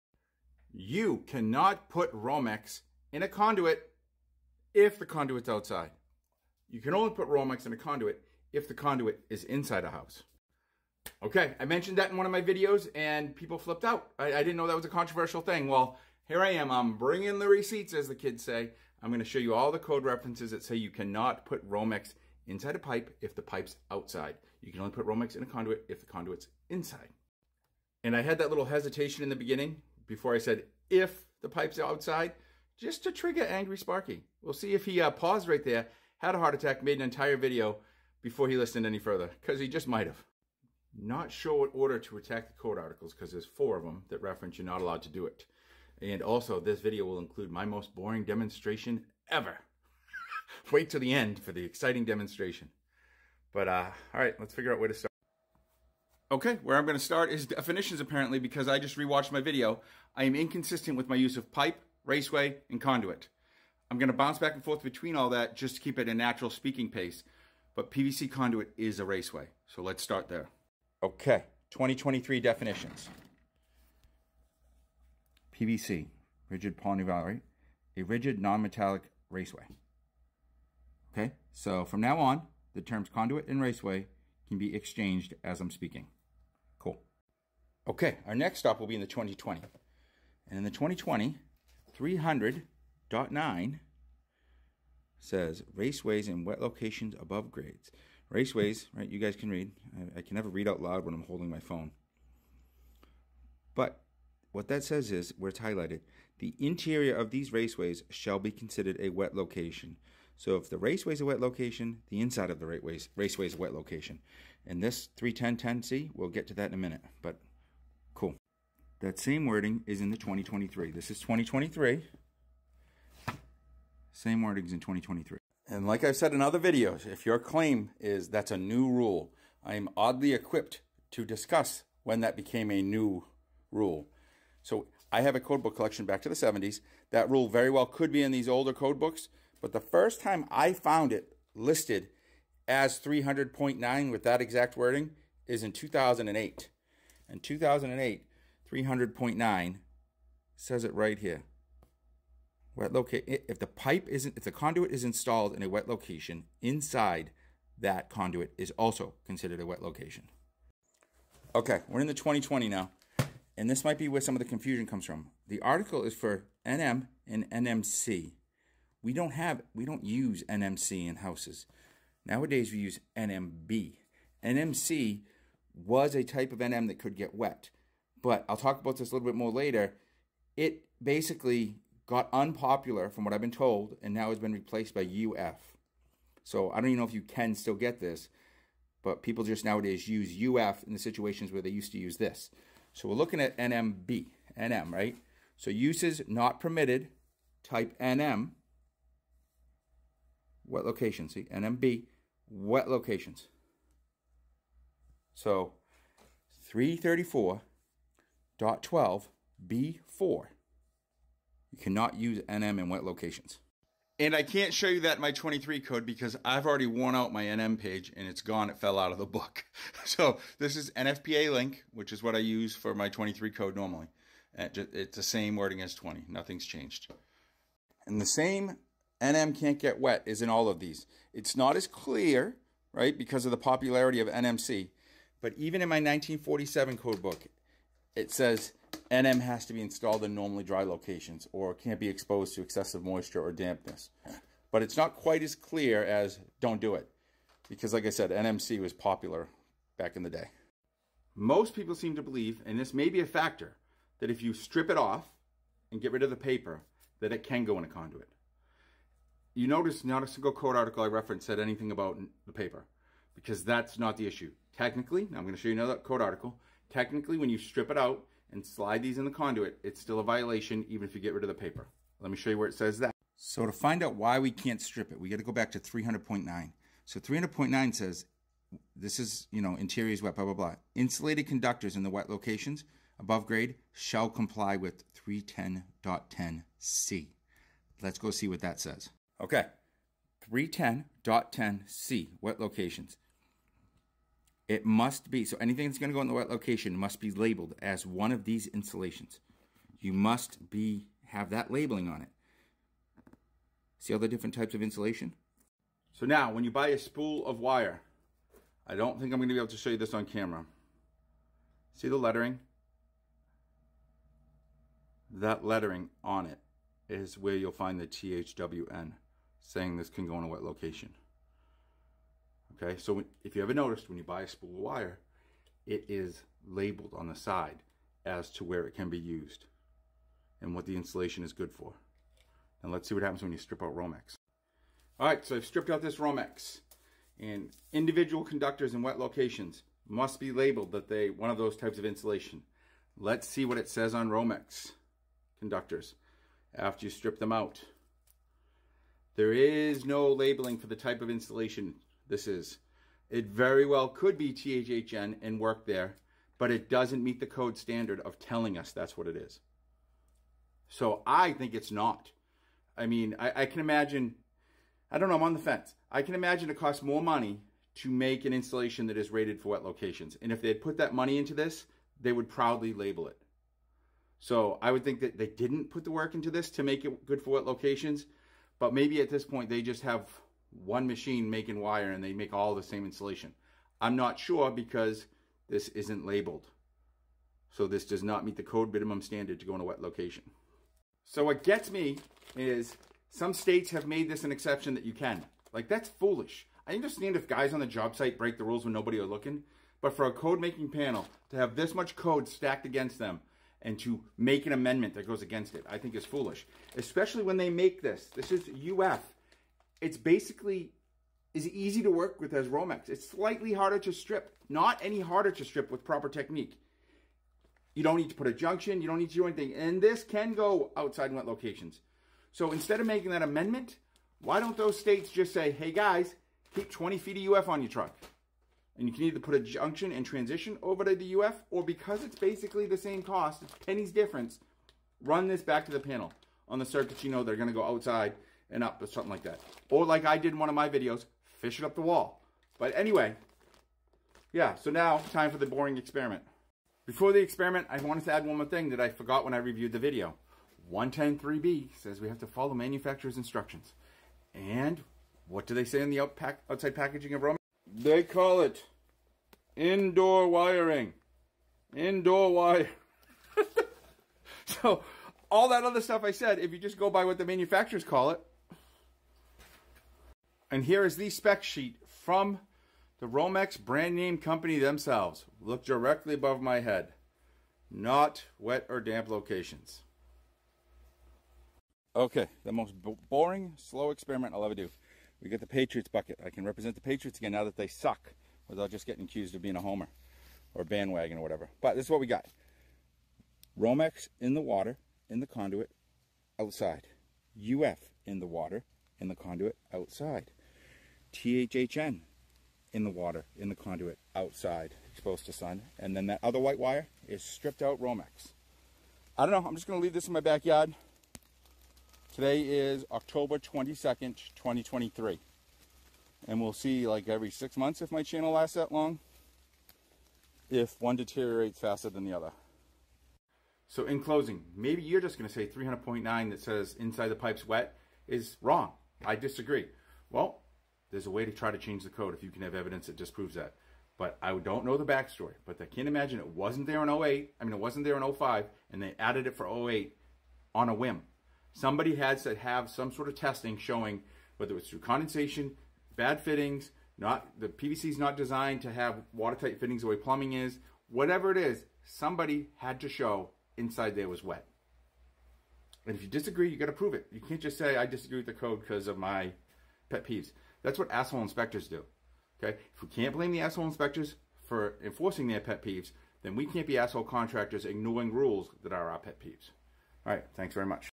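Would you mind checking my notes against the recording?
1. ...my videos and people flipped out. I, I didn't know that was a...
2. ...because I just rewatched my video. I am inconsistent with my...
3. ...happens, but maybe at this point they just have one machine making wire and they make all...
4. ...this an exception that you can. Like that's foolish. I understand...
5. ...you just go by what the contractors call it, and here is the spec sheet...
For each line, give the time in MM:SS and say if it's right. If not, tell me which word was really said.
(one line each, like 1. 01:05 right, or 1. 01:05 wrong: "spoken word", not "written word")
1. 00:12 right
2. 00:58 right
3. 06:17 wrong: "locations", not "happens"
4. 06:34 right
5. 07:46 wrong: "manufacturers", not "contractors".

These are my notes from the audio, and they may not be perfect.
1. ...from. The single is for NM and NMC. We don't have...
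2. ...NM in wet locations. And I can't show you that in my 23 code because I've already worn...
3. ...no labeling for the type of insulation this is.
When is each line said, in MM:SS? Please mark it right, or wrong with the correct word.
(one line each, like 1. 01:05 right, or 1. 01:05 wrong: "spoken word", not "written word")
1. 02:45 wrong: "article", not "single"
2. 03:32 right
3. 05:50 right.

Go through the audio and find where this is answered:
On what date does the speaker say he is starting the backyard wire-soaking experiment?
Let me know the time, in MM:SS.
08:33.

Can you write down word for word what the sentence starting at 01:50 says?
So if the raceway is a wet location, the inside of the raceways, raceway is a wet location.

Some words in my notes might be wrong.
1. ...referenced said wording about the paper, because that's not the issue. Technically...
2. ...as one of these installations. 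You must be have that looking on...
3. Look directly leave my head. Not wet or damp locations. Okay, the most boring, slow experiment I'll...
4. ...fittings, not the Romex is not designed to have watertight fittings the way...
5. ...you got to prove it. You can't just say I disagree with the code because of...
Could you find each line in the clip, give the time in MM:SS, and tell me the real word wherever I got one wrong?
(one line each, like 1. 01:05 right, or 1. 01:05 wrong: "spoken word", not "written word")
1. 04:21 wrong: "anything", not "wording"
2. 04:57 wrong: "labeling", not "looking"
3. 07:55 wrong: "above", not "leave"
4. 09:06 wrong: "PVC", not "Romex"
5. 09:16 right.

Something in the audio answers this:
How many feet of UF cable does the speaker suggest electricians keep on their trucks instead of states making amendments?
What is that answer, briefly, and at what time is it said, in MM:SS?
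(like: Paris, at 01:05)
20 feet, at 07:06.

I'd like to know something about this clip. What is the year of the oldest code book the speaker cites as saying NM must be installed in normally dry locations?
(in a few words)
1947.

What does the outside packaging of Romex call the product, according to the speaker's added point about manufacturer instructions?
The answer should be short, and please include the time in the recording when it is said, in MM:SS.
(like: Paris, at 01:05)
Indoor wire, at 07:41.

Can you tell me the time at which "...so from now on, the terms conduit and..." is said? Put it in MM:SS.
01:21.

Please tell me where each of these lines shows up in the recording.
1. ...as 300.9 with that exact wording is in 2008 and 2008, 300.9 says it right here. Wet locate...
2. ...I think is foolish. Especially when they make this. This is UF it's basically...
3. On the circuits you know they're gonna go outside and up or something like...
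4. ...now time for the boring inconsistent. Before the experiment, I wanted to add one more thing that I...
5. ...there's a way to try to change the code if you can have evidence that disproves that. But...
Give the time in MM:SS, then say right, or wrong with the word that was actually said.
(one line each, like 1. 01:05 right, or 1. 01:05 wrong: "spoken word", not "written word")
1. 02:22 right
2. 06:45 right
3. 07:16 right
4. 07:24 wrong: "experiment", not "inconsistent"
5. 08:51 right.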